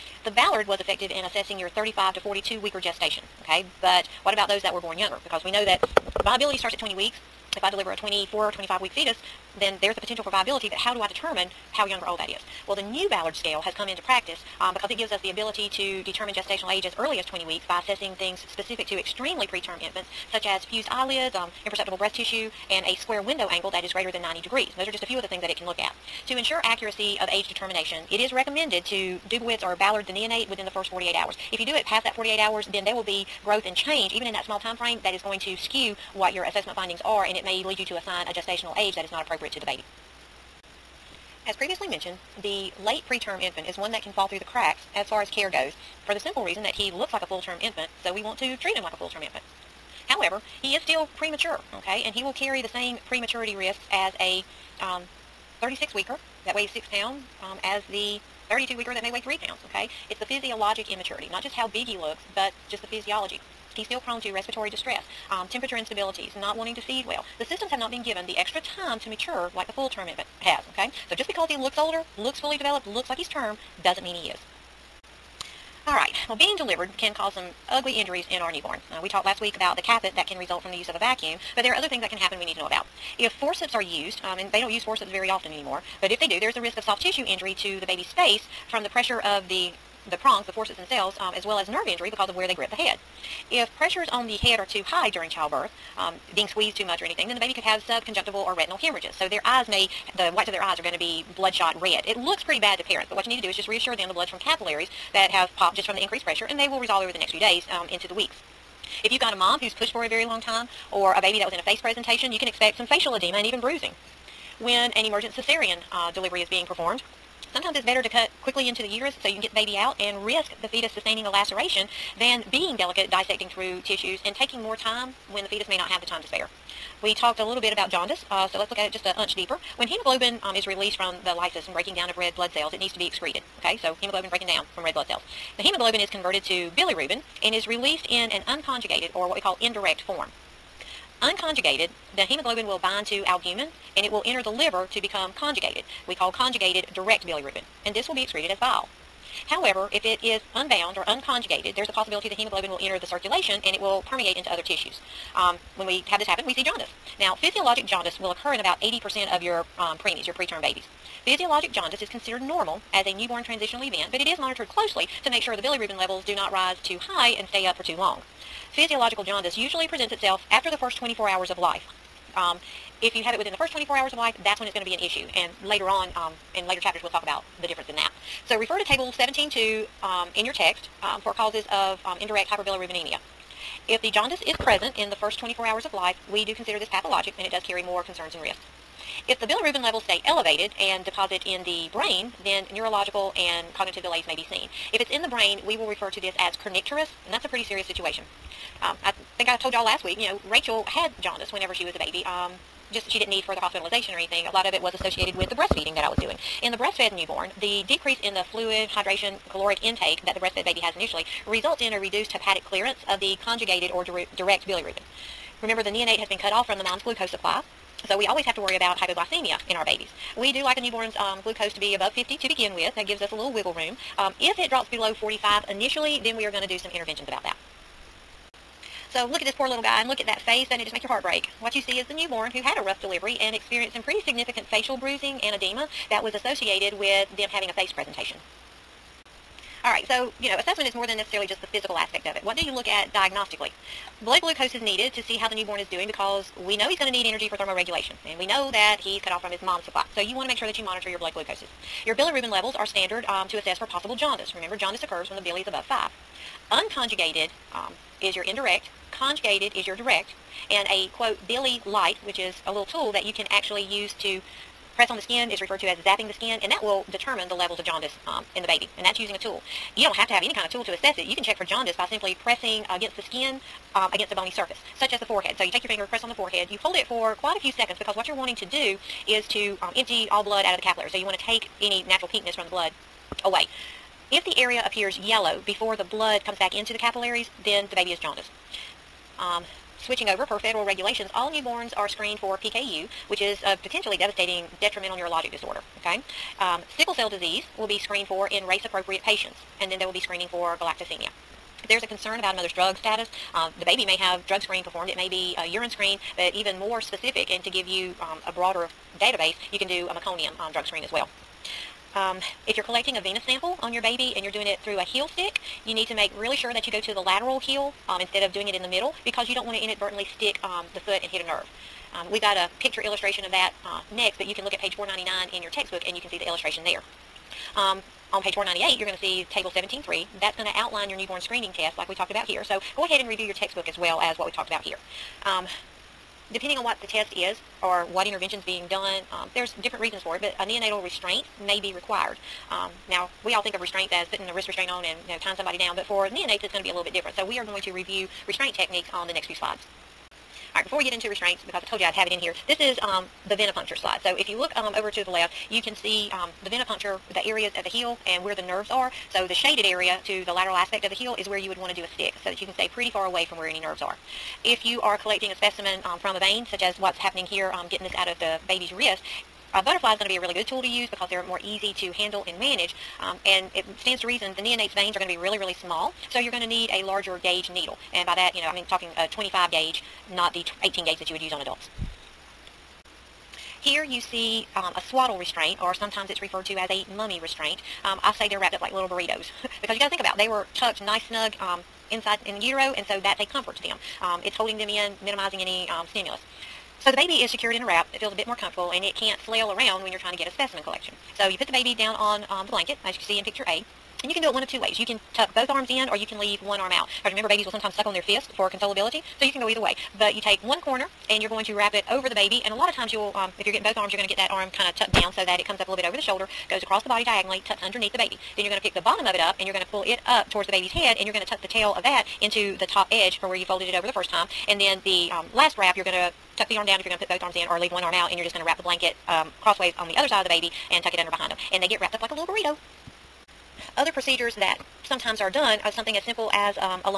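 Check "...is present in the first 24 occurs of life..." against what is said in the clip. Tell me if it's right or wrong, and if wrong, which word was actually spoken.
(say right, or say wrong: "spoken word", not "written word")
wrong: "hours", not "occurs".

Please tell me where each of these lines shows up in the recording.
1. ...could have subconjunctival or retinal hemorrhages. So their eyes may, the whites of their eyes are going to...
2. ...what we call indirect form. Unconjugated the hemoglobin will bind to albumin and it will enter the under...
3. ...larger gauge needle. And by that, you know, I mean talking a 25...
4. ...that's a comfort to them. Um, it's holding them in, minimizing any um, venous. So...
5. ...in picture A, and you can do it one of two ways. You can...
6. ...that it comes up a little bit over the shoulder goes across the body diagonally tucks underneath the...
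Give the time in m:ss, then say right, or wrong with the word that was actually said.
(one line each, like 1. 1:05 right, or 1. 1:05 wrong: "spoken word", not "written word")
1. 1:37 right
2. 2:19 wrong: "liver", not "under"
3. 6:17 right
4. 6:33 wrong: "stimulus", not "venous"
5. 6:43 right
6. 6:55 right.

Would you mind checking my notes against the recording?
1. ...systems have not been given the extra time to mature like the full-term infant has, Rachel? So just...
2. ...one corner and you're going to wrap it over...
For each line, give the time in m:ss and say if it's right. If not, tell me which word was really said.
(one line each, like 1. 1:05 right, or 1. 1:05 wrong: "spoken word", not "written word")
1. 1:07 wrong: "Okay", not "Rachel"
2. 6:50 right.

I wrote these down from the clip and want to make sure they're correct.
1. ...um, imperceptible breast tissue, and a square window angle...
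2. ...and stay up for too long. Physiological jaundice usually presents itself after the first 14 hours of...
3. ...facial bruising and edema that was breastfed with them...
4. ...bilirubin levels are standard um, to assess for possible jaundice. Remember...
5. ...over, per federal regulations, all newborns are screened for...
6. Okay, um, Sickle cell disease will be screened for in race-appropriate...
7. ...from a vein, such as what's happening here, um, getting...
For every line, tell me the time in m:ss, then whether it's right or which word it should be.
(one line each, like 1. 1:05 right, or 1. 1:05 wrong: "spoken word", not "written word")
1. 0:21 right
2. 2:47 wrong: "24", not "14"
3. 3:54 wrong: "associated", not "breastfed"
4. 4:12 right
5. 4:50 right
6. 4:56 right
7. 6:06 right.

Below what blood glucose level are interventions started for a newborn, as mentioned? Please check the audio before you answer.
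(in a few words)
45.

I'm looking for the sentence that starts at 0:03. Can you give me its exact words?
But what about those that were born younger?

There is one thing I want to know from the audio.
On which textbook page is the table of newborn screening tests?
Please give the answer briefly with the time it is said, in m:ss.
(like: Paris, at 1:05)
498, at 5:28.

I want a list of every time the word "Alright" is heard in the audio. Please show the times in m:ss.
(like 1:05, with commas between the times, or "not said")
1:15, 5:50.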